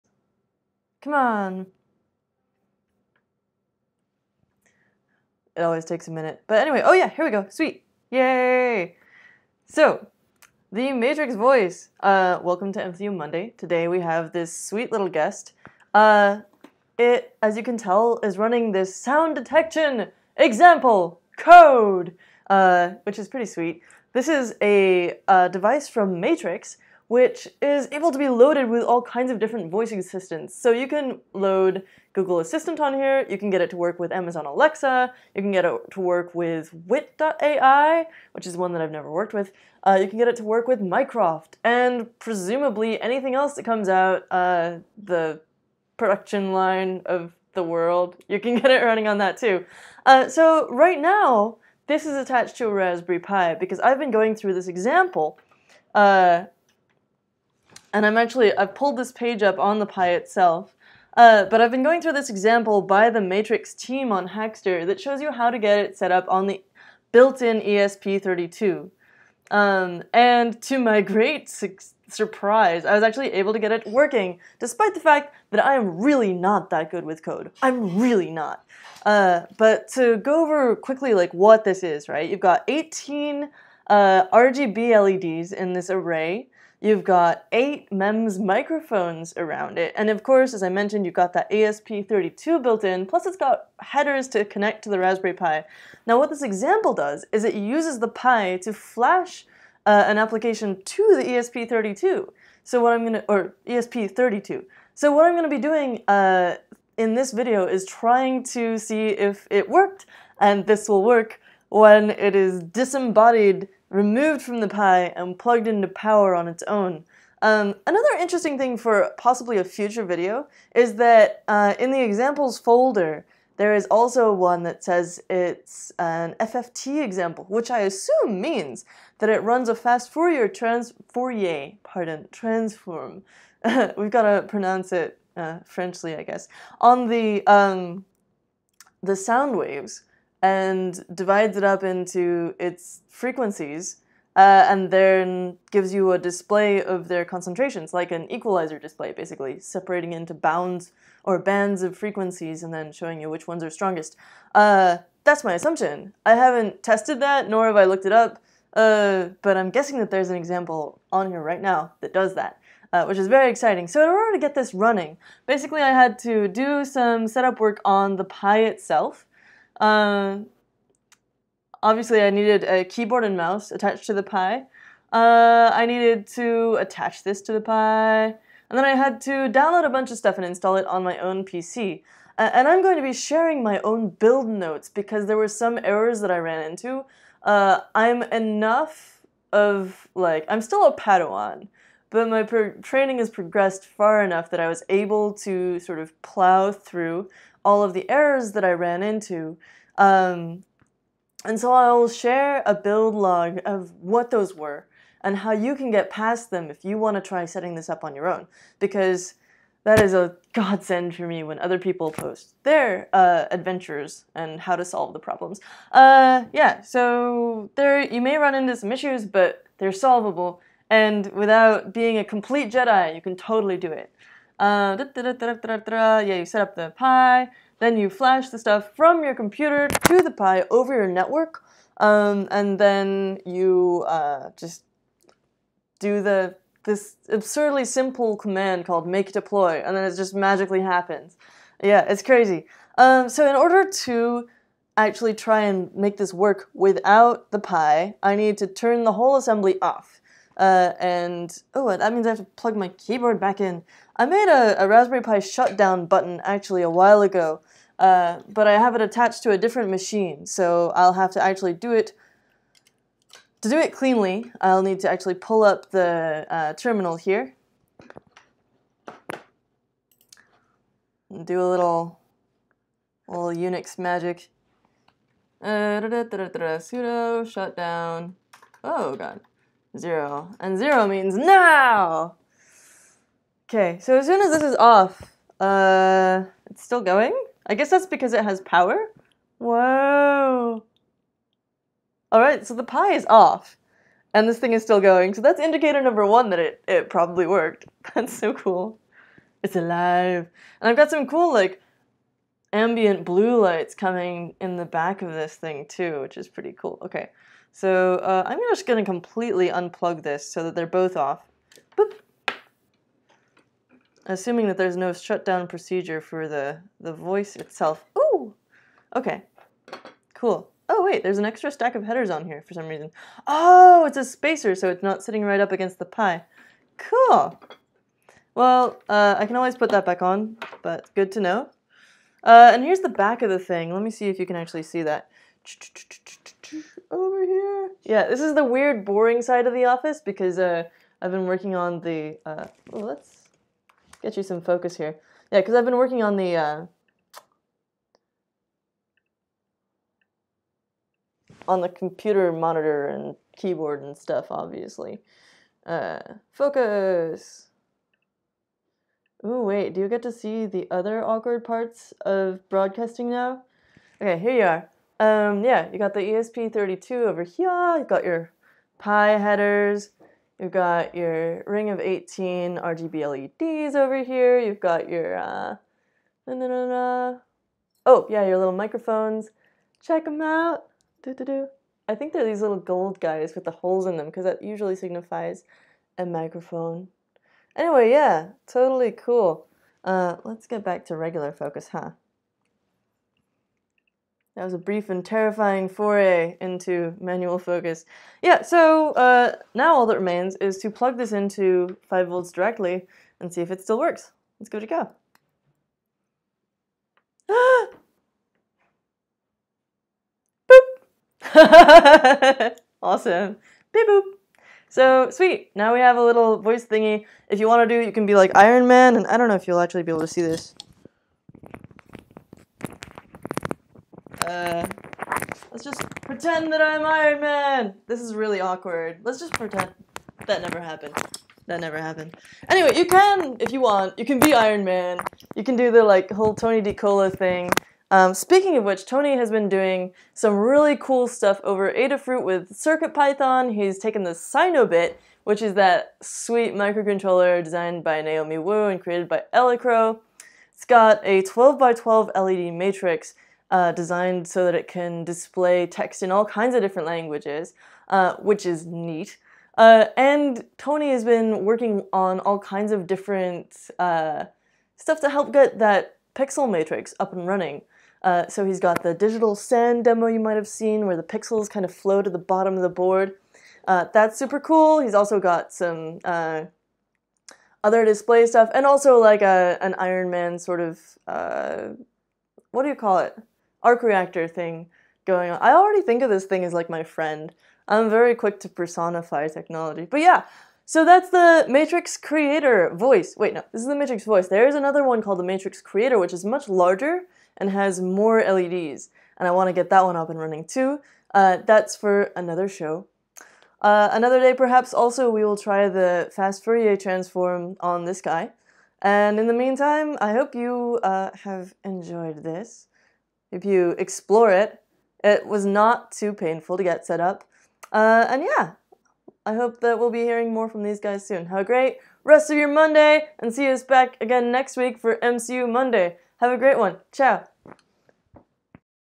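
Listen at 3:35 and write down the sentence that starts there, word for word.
Uh, yeah, so there you may run into some issues, but they're solvable.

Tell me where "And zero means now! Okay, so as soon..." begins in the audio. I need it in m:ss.
4:40.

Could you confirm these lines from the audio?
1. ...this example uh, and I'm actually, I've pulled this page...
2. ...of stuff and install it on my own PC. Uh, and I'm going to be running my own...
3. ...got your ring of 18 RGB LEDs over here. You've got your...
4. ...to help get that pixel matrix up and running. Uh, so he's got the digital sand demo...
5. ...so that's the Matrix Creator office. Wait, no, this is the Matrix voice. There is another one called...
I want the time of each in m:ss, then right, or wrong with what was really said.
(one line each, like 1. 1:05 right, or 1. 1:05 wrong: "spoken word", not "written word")
1. 0:54 right
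2. 3:00 wrong: "sharing", not "running"
3. 6:10 right
4. 7:45 right
5. 8:10 wrong: "voice", not "office".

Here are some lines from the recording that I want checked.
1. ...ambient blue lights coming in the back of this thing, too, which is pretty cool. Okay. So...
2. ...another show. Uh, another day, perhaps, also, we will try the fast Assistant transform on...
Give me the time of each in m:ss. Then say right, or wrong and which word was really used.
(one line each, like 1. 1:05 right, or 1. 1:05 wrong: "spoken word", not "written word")
1. 5:02 right
2. 8:22 wrong: "Fourier", not "Assistant".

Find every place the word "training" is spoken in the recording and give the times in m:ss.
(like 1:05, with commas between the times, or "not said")
3:12.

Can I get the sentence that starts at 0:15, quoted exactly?
Uh, it, as you can tell, is running this sound detection example code, uh, which is pretty sweet.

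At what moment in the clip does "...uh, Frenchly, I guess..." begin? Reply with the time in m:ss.
2:15.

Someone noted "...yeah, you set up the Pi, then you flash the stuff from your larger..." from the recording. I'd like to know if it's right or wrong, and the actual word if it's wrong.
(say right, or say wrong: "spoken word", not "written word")
wrong: "computer", not "larger".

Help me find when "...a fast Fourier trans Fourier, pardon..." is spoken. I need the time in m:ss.
2:09.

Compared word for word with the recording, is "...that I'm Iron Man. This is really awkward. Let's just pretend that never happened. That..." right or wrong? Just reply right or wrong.
right.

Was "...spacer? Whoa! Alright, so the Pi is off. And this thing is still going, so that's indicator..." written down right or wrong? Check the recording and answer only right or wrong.
wrong.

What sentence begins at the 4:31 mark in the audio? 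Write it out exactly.
And do a little, little Unix magic.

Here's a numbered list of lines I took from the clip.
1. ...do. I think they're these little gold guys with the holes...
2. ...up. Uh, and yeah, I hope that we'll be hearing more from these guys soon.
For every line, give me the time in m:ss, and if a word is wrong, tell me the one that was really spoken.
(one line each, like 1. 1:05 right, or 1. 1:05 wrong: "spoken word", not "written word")
1. 6:21 right
2. 8:37 right.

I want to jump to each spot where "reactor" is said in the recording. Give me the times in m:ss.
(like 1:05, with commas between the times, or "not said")
8:04.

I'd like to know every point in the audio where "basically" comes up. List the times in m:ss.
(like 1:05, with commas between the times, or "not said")
2:29, 2:45.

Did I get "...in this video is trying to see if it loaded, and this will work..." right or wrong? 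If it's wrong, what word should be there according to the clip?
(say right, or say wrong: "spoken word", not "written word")
wrong: "worked", not "loaded".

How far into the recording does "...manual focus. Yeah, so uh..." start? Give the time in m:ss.
6:37.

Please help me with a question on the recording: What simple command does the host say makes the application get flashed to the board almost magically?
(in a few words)
make deploy.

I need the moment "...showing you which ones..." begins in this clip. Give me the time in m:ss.
2:32.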